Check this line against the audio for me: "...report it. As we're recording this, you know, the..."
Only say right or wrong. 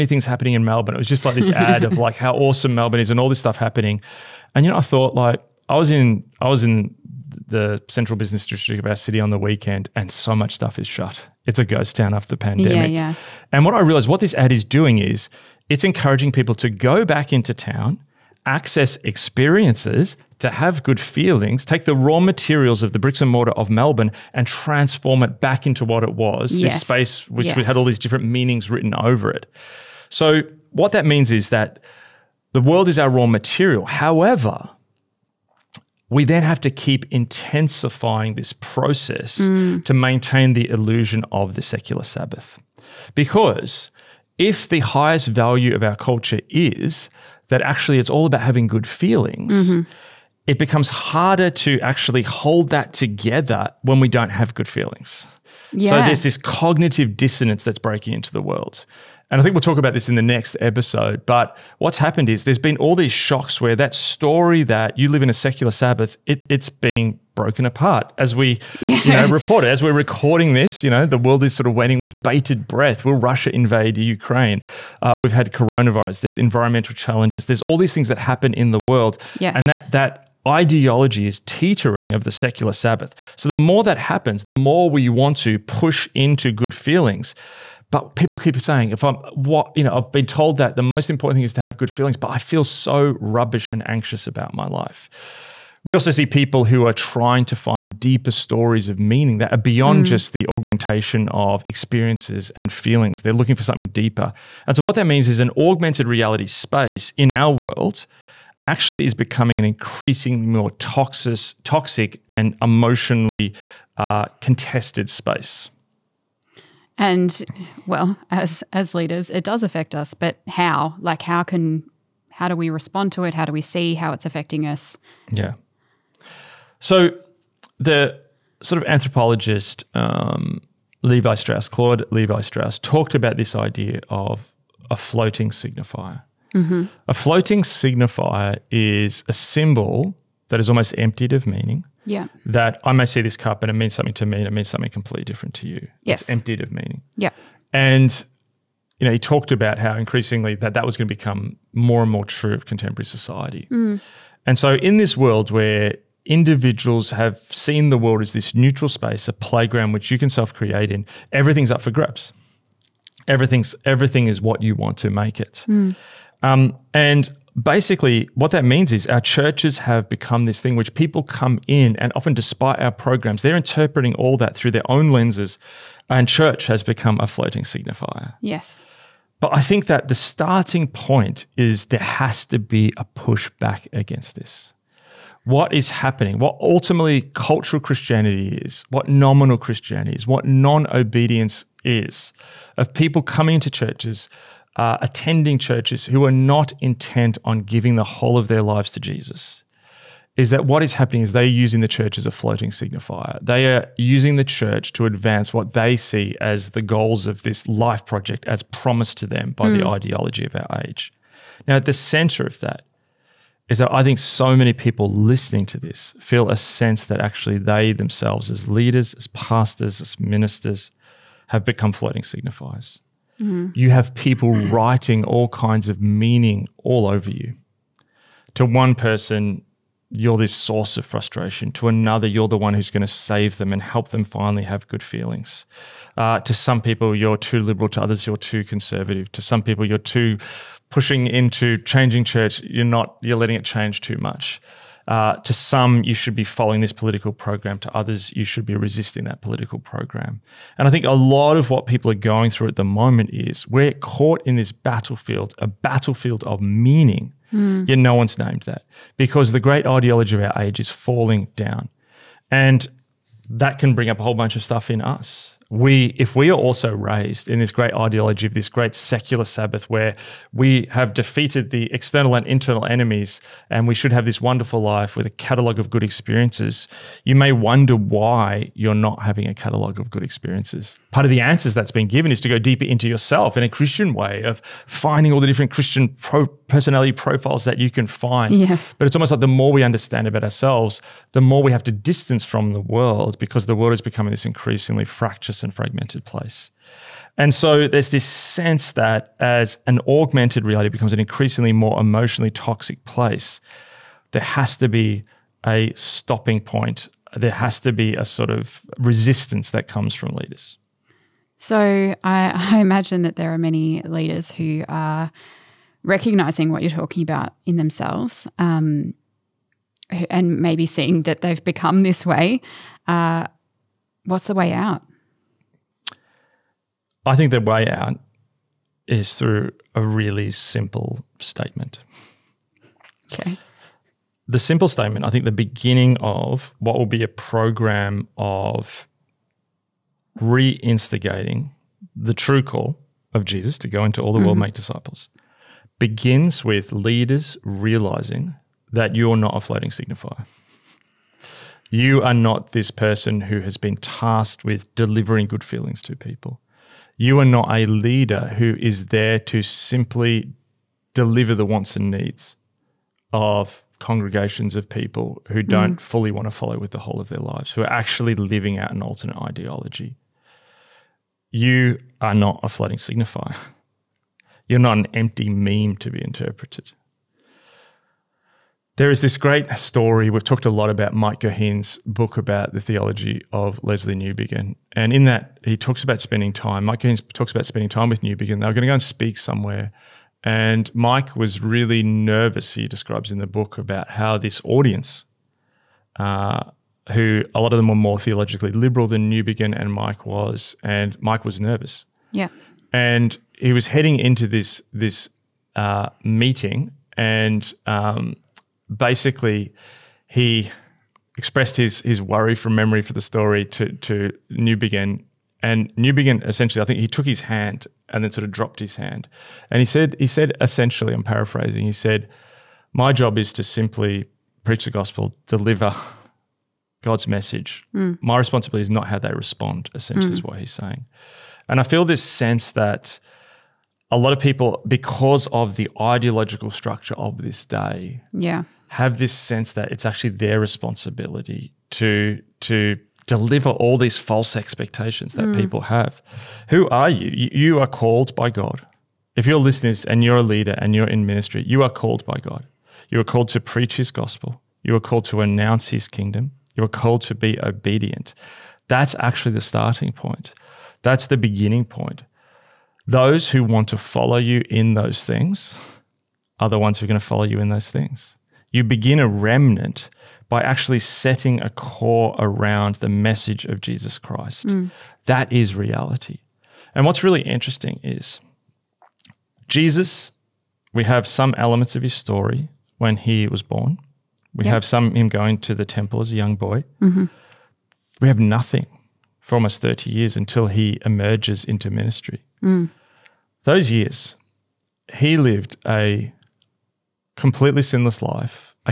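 right.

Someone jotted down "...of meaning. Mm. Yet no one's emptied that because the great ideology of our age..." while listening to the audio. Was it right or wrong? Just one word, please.
wrong.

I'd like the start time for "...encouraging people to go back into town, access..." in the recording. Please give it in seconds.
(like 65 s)
15 s.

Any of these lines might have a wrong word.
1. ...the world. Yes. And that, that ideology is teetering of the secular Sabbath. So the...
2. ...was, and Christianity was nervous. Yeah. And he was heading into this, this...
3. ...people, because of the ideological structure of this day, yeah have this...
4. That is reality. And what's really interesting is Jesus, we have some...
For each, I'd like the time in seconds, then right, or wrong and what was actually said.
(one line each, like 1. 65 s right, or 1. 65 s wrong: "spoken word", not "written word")
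1. 78 s right
2. 400 s wrong: "Mike", not "Christianity"
3. 434 s right
4. 475 s right.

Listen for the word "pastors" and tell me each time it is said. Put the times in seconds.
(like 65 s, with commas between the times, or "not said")
219 s.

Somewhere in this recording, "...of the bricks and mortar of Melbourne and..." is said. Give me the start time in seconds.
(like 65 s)
22 s.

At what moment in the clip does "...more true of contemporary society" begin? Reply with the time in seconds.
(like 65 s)
152 s.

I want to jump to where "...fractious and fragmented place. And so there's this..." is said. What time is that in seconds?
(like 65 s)
295 s.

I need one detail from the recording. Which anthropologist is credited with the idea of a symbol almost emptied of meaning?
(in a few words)
Claude Levi Strauss.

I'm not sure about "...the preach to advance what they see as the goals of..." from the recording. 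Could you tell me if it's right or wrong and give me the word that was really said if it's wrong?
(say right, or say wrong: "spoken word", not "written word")
wrong: "church", not "preach".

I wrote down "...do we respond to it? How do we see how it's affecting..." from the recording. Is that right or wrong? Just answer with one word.
right.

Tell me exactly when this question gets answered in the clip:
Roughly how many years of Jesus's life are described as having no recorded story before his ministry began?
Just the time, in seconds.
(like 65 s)
489 s.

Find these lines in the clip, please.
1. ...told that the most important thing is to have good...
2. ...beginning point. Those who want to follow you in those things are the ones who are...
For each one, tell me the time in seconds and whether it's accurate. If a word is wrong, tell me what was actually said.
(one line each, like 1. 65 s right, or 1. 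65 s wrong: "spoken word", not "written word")
1. 90 s right
2. 461 s right.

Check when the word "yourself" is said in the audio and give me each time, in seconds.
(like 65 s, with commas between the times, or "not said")
283 s.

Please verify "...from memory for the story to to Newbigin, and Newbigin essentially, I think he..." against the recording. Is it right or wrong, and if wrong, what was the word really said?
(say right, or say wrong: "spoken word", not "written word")
right.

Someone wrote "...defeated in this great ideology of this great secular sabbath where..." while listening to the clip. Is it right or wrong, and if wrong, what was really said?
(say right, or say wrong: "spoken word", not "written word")
wrong: "raised", not "defeated".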